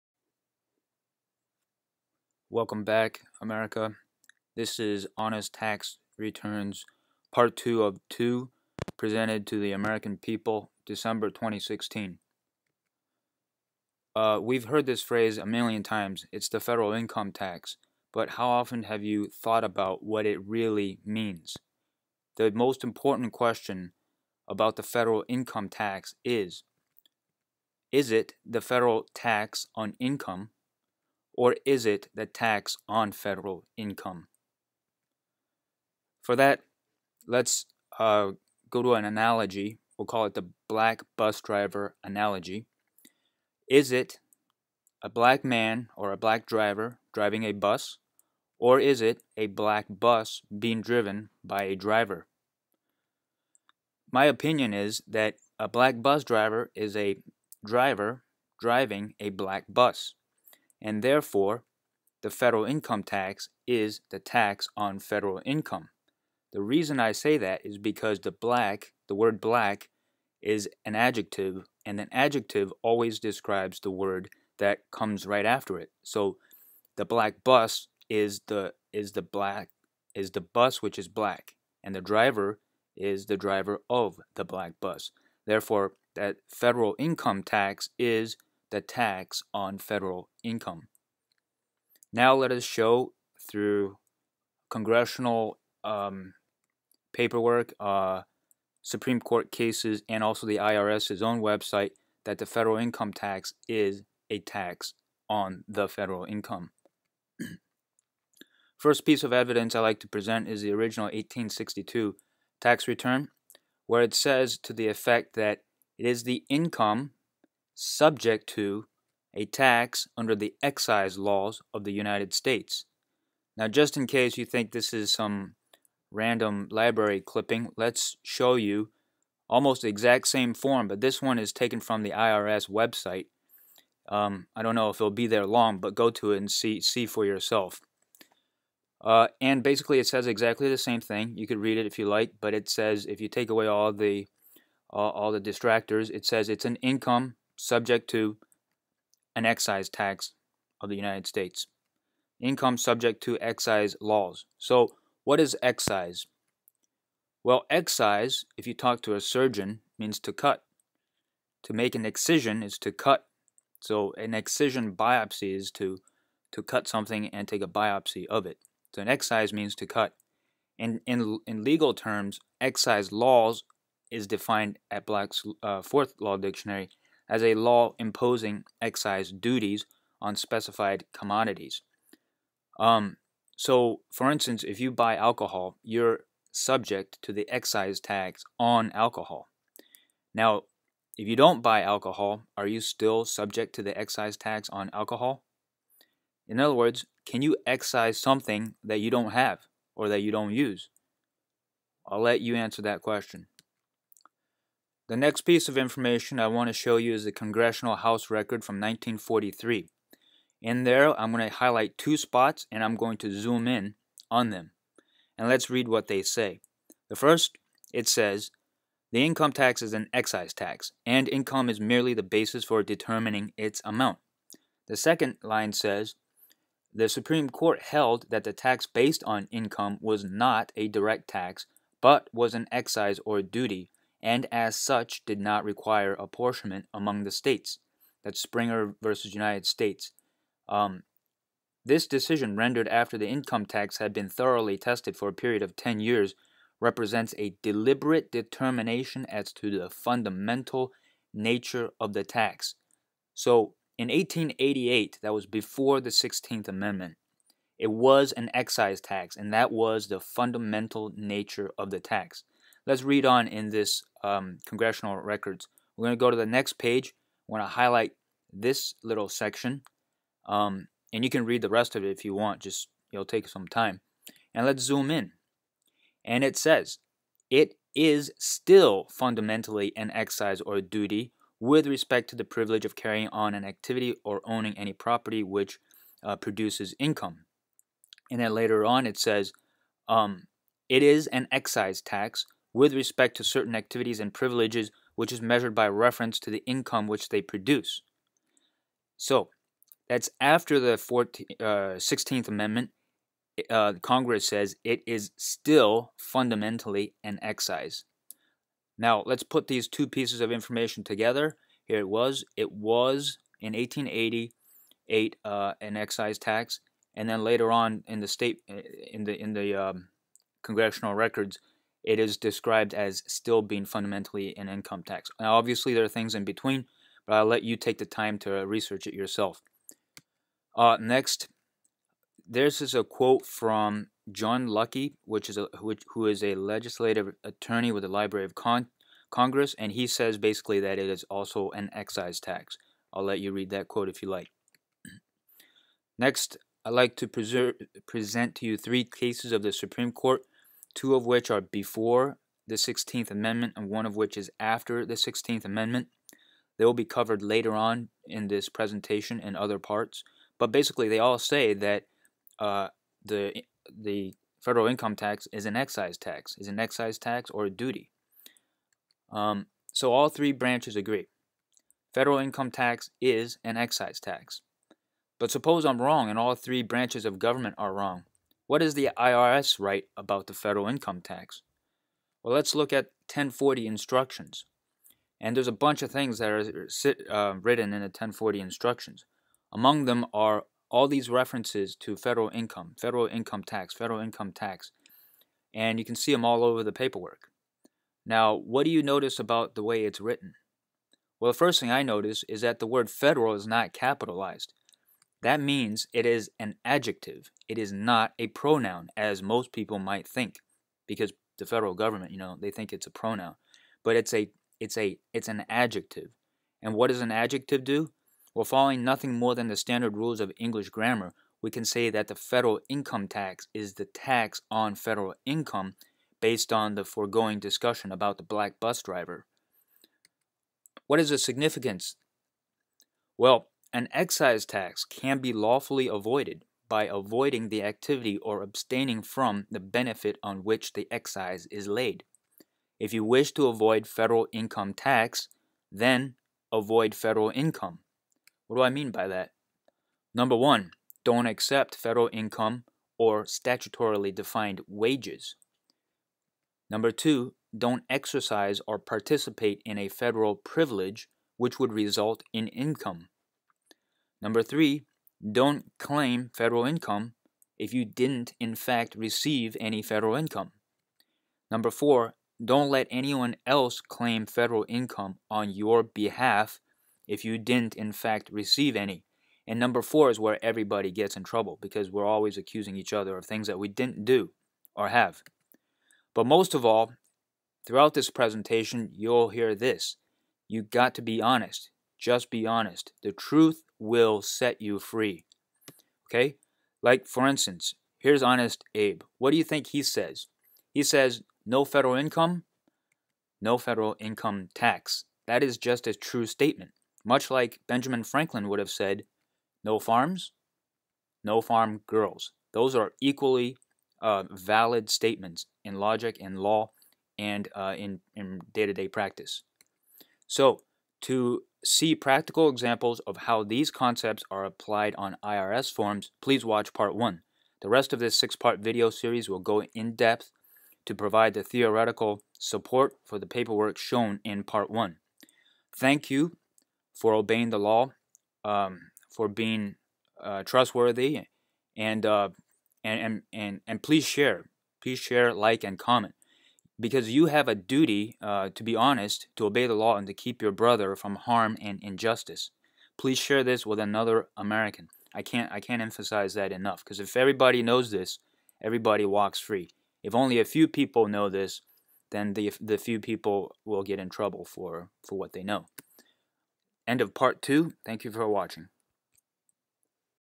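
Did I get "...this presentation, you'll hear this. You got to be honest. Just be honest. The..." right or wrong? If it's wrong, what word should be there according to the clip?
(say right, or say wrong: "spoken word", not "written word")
right.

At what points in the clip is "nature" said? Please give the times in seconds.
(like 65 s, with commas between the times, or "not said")
251 s, 261 s.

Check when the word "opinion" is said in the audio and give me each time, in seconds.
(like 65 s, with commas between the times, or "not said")
54 s.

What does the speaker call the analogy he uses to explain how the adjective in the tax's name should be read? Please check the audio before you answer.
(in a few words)
Black bus driver analogy.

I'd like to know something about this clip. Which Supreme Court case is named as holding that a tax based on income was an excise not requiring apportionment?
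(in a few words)
Springer versus United States.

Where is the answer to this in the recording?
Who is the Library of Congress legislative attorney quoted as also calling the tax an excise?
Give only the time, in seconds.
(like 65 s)
334 s.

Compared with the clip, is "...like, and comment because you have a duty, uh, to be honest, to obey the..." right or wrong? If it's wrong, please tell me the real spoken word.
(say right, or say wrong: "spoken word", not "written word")
right.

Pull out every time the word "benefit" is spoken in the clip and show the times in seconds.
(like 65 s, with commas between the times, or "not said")
439 s.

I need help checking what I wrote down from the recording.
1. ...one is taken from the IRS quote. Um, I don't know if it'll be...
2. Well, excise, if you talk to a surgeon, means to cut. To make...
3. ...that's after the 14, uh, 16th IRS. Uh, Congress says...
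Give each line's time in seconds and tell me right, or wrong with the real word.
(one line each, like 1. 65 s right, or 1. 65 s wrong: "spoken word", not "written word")
1. 131 s wrong: "website", not "quote"
2. 157 s right
3. 300 s wrong: "Amendment", not "IRS".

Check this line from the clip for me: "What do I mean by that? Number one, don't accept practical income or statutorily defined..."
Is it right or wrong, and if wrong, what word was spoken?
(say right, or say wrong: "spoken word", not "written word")
wrong: "federal", not "practical".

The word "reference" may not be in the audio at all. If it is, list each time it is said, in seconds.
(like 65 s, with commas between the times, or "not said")
295 s, 391 s.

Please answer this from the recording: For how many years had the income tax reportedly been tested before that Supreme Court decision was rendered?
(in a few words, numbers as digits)
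10 years.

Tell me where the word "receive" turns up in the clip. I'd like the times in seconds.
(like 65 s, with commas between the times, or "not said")
469 s, 478 s.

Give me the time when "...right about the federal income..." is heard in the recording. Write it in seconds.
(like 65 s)
379 s.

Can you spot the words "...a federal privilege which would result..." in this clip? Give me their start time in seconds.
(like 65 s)
459 s.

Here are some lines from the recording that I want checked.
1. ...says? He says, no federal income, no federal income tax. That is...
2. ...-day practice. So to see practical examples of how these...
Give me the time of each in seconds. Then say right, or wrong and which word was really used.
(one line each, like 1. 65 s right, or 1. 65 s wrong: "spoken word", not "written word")
1. 500 s right
2. 519 s right.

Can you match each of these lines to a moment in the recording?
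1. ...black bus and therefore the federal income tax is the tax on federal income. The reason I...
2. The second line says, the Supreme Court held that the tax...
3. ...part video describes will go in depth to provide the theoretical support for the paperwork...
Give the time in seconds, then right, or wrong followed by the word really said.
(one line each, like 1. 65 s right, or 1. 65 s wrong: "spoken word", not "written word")
1. 59 s right
2. 224 s right
3. 528 s wrong: "series", not "describes".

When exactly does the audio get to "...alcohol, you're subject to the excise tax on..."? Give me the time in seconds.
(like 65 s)
185 s.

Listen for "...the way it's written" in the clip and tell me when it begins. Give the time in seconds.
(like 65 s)
399 s.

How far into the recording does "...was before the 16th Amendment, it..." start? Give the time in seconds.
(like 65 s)
255 s.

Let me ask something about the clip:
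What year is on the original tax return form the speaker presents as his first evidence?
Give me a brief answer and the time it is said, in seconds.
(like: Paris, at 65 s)
1862, at 111 s.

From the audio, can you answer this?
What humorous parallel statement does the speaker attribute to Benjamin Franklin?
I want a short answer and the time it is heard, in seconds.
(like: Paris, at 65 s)
No farms, no farm girls, at 509 s.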